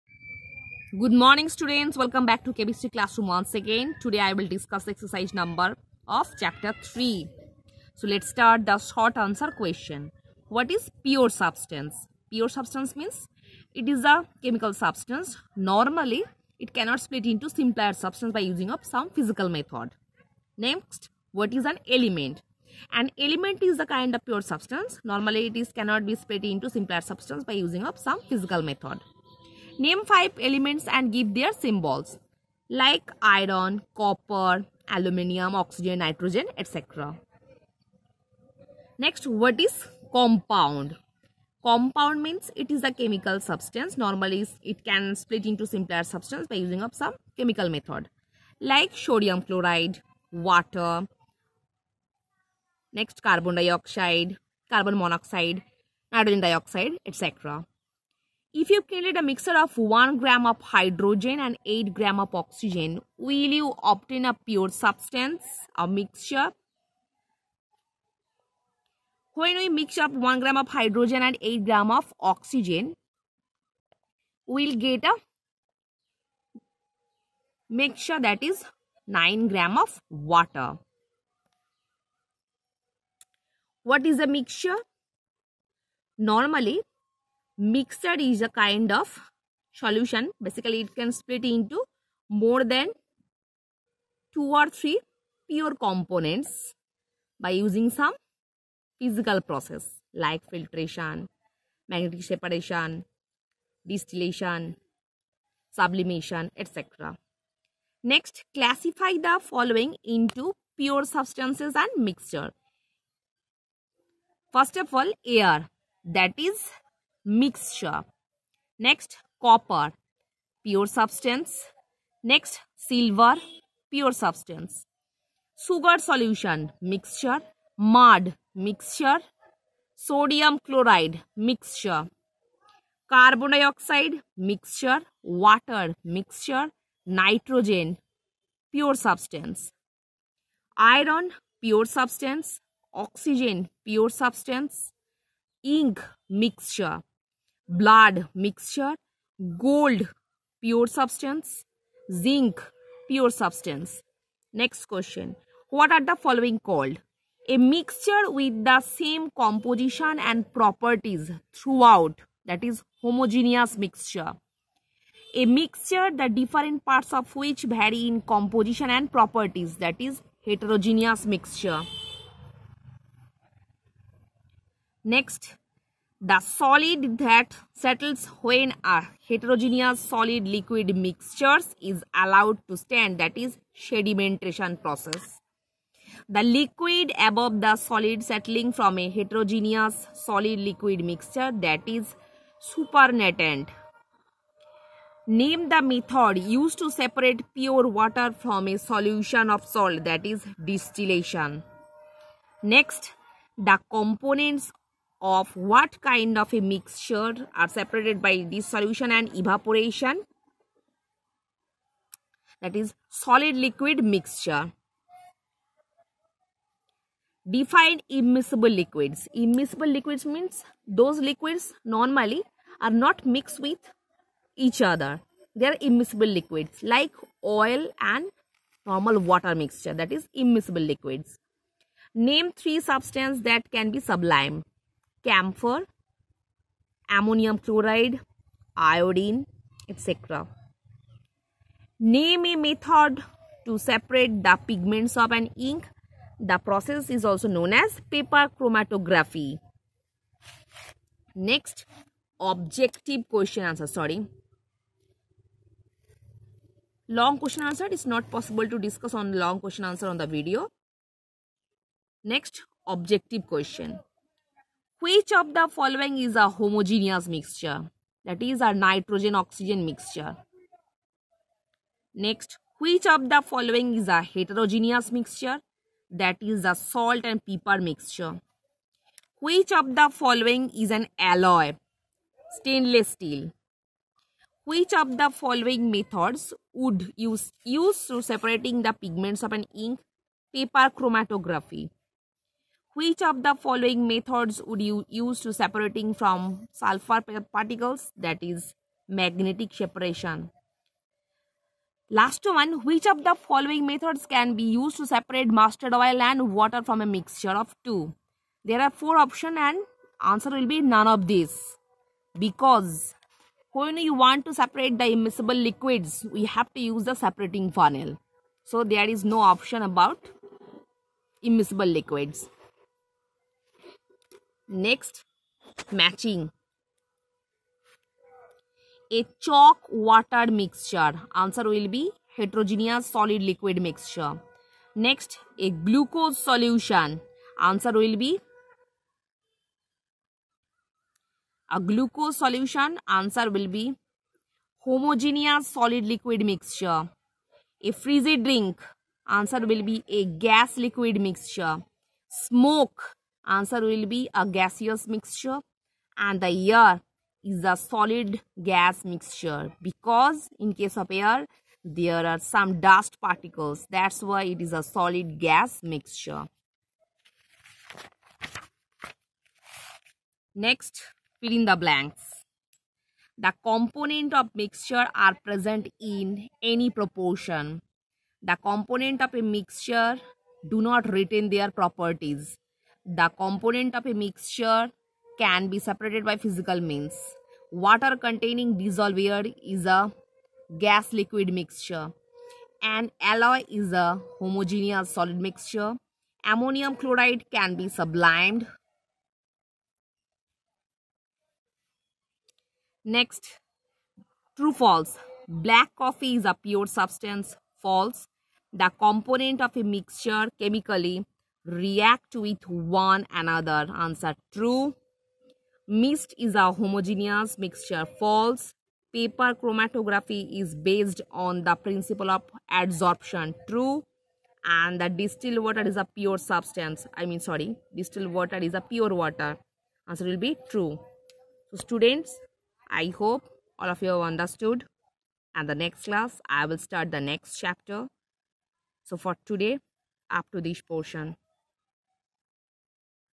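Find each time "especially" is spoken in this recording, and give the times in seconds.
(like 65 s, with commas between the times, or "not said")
not said.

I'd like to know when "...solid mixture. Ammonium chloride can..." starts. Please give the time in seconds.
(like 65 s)
395 s.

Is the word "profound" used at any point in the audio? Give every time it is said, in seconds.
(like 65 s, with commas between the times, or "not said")
not said.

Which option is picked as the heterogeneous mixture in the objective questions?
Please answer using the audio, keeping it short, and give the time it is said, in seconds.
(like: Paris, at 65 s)
Salt and pepper, at 276 s.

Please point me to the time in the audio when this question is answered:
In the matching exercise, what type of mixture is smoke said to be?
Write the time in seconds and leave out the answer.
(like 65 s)
354 s.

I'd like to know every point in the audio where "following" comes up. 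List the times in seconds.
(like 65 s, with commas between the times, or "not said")
109 s, 156 s, 265 s, 273 s, 280 s, 285 s, 293 s, 303 s.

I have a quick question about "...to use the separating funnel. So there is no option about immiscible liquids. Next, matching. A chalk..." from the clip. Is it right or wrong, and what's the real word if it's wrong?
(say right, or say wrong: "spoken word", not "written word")
right.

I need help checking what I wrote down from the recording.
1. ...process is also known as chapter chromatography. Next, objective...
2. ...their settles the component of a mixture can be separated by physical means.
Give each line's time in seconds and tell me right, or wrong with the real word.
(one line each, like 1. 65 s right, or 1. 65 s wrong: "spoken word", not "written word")
1. 246 s wrong: "paper", not "chapter"
2. 381 s wrong: "properties", not "settles".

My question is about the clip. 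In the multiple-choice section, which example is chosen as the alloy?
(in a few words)
Stainless steel.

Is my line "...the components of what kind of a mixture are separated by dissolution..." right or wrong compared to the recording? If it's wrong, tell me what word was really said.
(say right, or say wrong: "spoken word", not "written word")
right.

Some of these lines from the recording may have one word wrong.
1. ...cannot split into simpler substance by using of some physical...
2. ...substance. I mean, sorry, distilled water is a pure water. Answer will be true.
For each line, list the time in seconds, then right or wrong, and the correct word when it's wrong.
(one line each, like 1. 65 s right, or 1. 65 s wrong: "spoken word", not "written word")
1. 16 s right
2. 426 s right.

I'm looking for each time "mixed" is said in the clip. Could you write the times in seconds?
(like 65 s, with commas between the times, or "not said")
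223 s.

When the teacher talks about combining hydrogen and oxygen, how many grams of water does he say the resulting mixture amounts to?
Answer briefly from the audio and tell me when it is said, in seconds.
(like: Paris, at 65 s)
9 grams, at 79 s.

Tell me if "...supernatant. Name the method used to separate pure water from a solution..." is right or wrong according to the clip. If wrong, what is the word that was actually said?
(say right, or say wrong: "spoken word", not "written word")
right.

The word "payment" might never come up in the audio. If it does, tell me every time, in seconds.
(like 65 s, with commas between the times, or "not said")
not said.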